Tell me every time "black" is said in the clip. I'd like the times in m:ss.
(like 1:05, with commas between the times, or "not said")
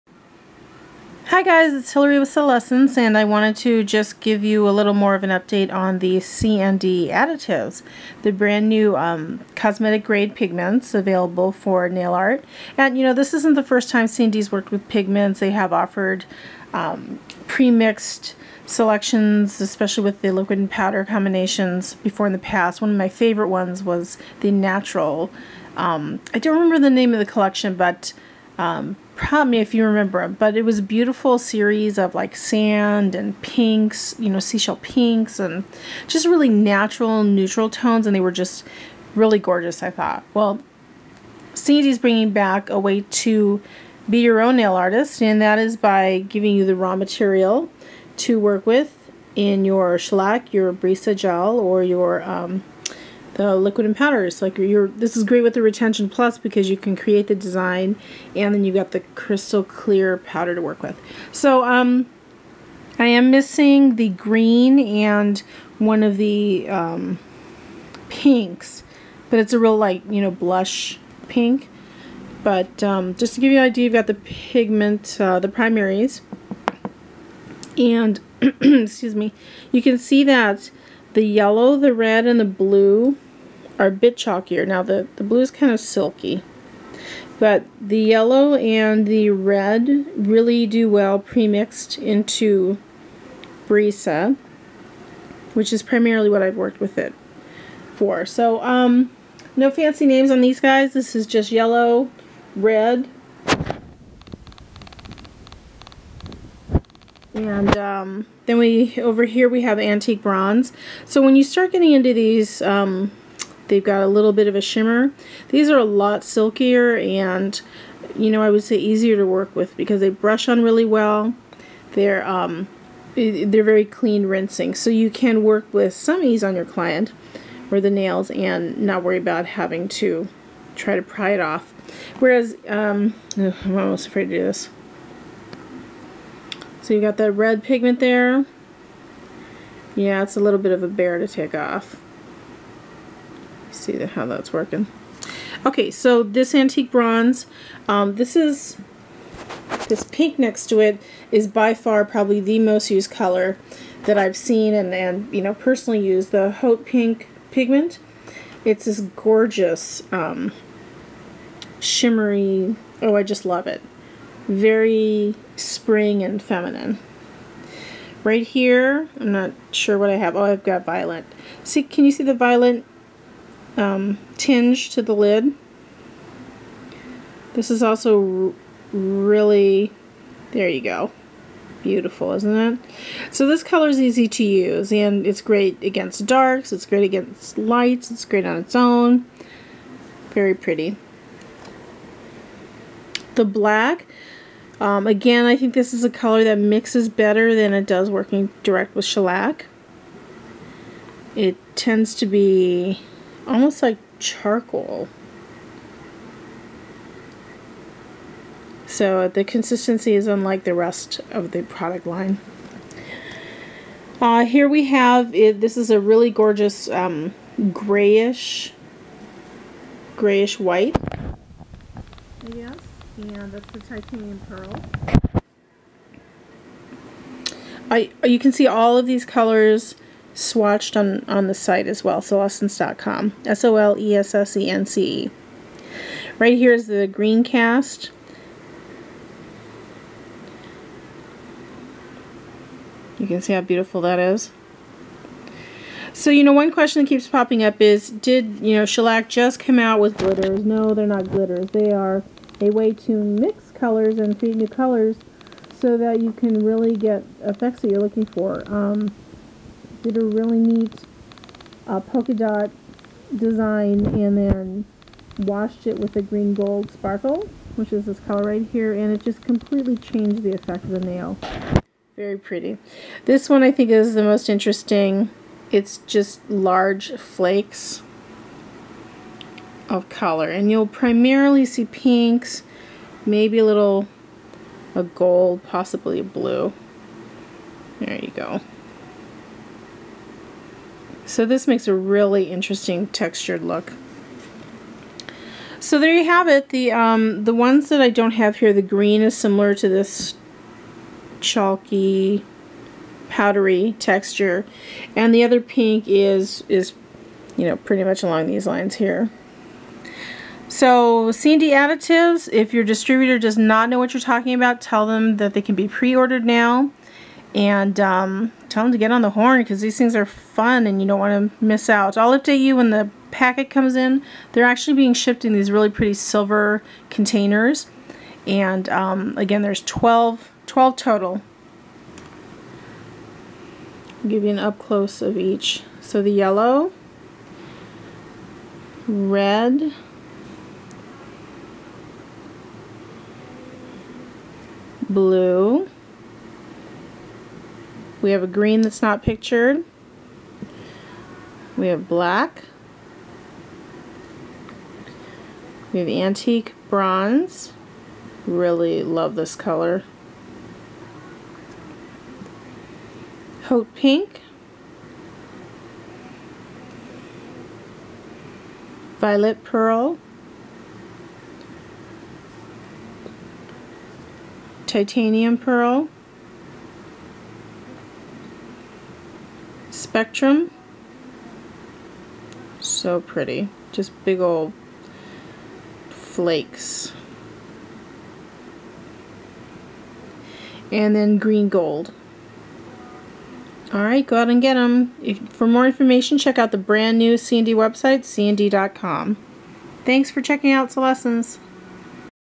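3:13, 5:52.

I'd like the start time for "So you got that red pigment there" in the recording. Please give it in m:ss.
2:16.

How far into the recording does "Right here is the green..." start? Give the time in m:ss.
3:56.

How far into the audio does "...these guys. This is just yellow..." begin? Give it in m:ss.
1:40.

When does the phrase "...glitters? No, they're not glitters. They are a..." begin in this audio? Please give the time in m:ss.
4:10.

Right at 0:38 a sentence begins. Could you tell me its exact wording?
And they were just really gorgeous, I thought.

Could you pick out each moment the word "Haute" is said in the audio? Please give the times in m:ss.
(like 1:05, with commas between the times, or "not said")
2:36, 6:03.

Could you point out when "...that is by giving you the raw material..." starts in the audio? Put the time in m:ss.
0:45.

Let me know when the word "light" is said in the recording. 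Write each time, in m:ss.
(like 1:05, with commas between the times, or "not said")
1:09, 3:07.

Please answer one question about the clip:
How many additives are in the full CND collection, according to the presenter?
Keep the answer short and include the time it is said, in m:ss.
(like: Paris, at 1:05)
12, at 5:30.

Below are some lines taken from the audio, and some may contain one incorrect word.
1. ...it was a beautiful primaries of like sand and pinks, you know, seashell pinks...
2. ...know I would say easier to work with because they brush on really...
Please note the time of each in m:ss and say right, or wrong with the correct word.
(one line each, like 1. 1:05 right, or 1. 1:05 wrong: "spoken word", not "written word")
1. 0:30 wrong: "series", not "primaries"
2. 1:58 right.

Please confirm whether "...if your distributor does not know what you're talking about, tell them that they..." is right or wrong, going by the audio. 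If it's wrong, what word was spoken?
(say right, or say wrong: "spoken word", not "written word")
right.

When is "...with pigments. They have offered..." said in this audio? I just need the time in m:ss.
0:14.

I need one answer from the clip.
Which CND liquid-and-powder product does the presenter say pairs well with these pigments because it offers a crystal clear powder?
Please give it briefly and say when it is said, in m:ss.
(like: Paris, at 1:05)
Retention Plus, at 0:55.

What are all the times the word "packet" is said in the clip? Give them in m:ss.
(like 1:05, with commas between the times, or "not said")
5:23.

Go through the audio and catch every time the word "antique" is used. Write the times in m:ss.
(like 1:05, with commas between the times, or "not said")
1:49, 2:26, 5:56.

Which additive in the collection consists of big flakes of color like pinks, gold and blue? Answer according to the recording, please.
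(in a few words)
Spectrum.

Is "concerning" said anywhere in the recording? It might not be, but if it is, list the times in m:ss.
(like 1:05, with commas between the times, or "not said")
not said.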